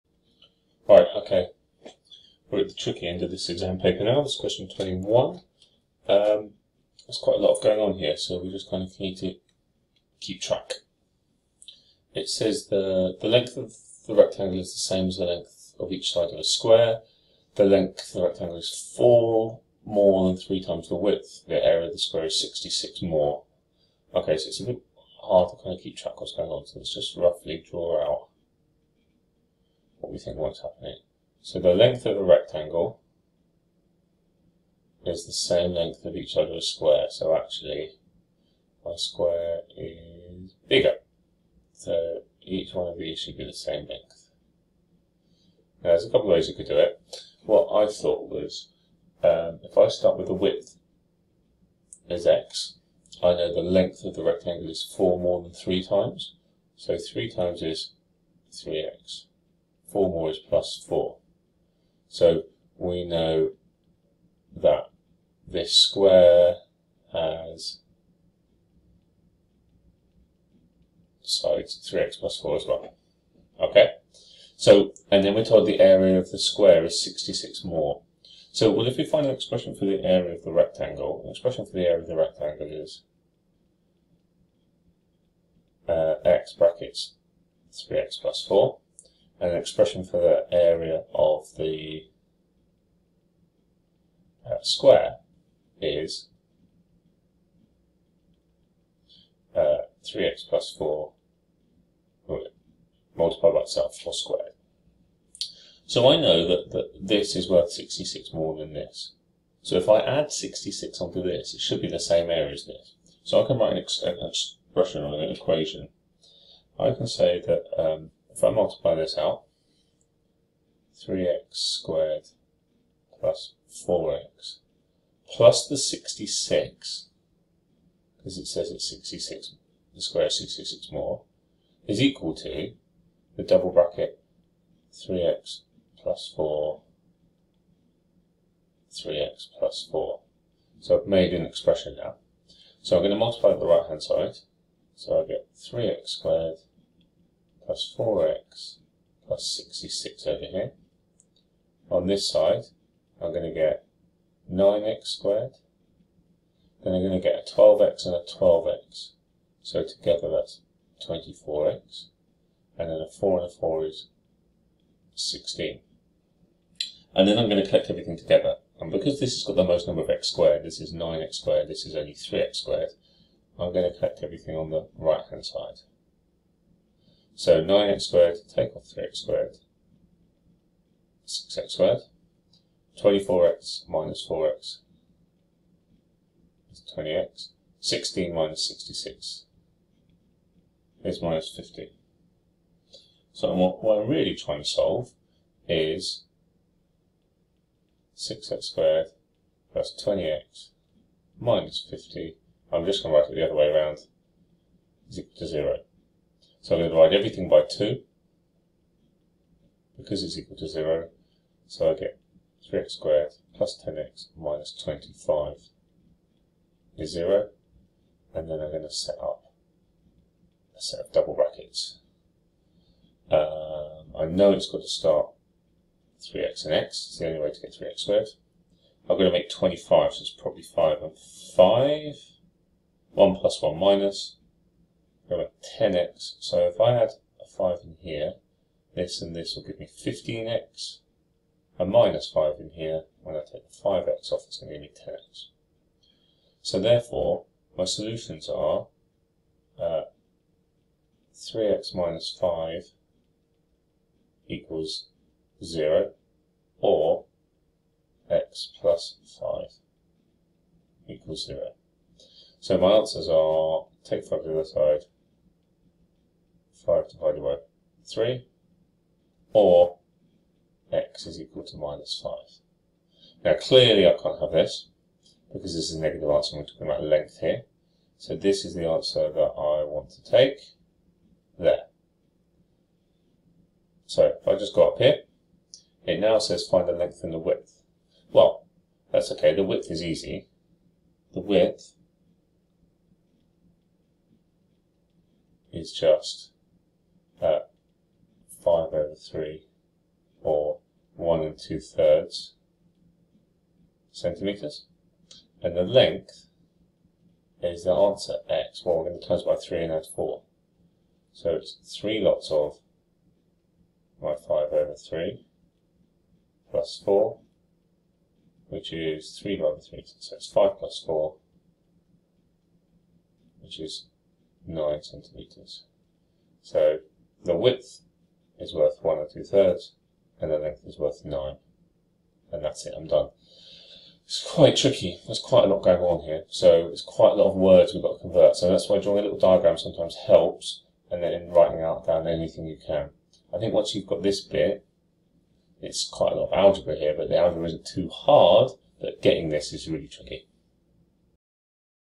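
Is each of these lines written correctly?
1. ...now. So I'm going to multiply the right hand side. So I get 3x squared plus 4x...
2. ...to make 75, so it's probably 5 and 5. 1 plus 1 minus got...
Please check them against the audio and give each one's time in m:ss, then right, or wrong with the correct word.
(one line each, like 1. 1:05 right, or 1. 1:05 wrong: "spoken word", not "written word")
1. 2:21 right
2. 3:49 wrong: "25", not "75".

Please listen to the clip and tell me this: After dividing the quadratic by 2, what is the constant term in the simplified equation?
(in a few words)
-25.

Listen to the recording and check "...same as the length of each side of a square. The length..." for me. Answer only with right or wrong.
right.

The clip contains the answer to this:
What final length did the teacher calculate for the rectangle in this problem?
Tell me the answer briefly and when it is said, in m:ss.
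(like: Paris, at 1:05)
9 cm, at 5:24.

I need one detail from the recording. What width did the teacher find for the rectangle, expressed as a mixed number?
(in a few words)
1 and 2/3 cm.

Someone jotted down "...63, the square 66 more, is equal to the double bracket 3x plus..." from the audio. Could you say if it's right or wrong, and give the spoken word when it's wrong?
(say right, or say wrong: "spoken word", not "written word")
wrong: "66", not "63".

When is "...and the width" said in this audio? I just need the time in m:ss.
4:47.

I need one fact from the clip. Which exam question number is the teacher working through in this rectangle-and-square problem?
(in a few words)
21.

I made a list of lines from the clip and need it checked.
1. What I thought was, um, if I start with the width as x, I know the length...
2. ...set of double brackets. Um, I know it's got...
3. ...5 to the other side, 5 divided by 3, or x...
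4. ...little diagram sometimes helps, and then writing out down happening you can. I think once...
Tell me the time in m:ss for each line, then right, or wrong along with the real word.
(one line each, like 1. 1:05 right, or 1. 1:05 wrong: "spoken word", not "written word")
1. 0:47 right
2. 3:40 right
3. 4:24 right
4. 5:39 wrong: "anything", not "happening".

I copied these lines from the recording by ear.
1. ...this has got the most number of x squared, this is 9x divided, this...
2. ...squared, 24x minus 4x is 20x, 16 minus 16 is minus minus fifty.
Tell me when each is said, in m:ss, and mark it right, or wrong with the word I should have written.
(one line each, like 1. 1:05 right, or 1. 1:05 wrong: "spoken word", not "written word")
1. 2:49 wrong: "squared", not "divided"
2. 3:01 wrong: "66", not "16".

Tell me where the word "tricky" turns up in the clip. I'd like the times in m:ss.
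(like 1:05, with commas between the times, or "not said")
0:02, 5:34, 5:50.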